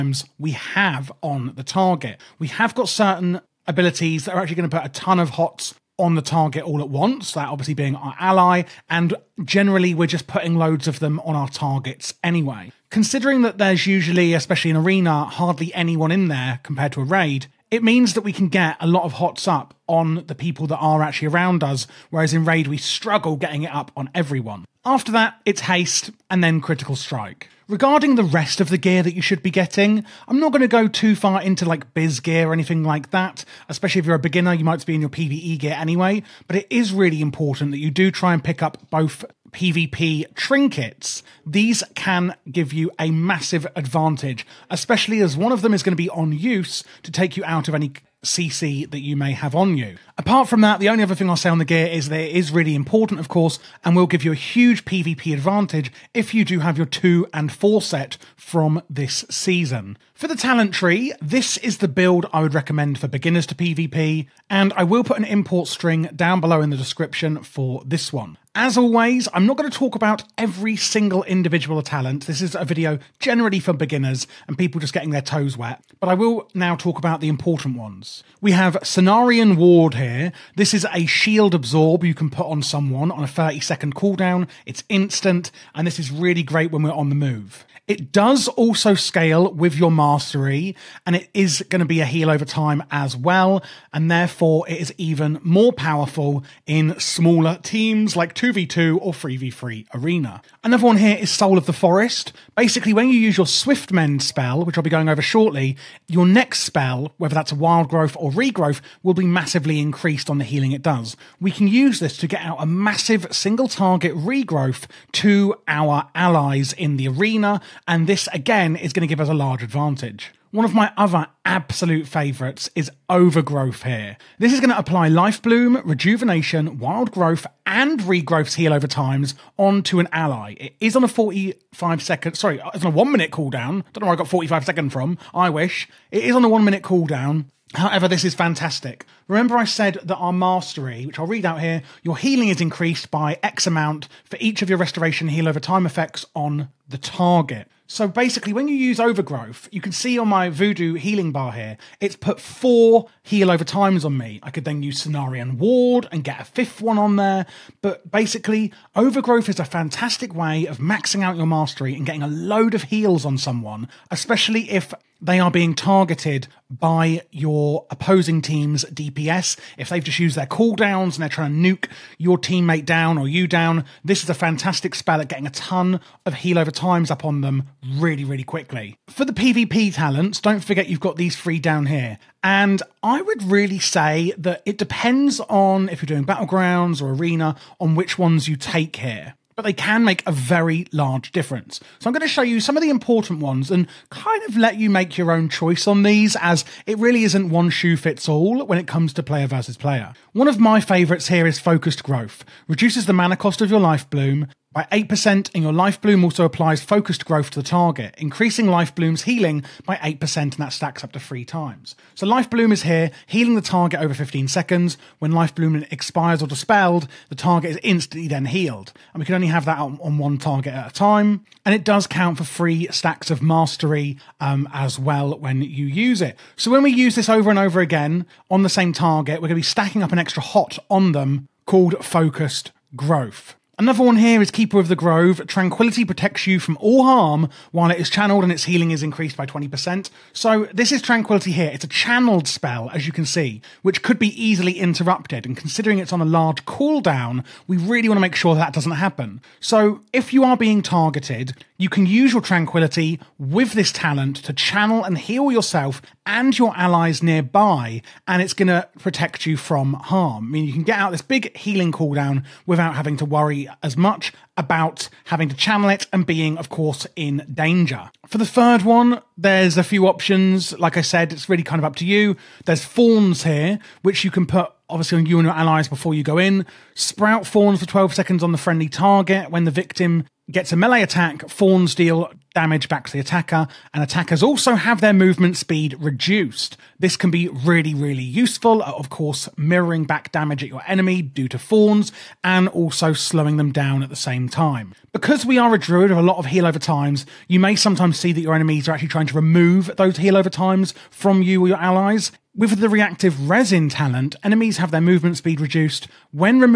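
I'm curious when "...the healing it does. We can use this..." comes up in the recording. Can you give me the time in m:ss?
1:50.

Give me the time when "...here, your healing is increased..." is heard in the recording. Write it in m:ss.
2:21.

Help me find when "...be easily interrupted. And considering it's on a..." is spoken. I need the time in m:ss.
4:04.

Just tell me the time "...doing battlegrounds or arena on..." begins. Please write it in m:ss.
3:06.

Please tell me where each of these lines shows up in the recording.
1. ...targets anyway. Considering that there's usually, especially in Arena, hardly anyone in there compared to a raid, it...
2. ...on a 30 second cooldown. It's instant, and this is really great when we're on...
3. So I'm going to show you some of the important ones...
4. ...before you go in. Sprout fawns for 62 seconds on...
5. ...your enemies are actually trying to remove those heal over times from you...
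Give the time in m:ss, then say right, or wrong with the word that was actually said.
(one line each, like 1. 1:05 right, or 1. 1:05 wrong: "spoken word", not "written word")
1. 0:11 right
2. 1:23 right
3. 3:11 right
4. 4:35 wrong: "12", not "62"
5. 4:58 right.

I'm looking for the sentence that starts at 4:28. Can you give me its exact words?
For the third one, there's a few options.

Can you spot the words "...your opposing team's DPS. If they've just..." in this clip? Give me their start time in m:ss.
2:47.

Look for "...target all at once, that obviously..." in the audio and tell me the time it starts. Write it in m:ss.
0:06.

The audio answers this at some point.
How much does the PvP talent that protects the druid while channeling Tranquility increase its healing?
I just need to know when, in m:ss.
3:59.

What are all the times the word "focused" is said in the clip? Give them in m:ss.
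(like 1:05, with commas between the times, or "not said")
3:21, 3:26, 3:52.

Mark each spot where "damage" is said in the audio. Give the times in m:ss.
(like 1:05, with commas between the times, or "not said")
4:42, 4:50.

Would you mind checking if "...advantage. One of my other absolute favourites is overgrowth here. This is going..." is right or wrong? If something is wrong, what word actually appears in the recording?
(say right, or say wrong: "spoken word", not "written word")
right.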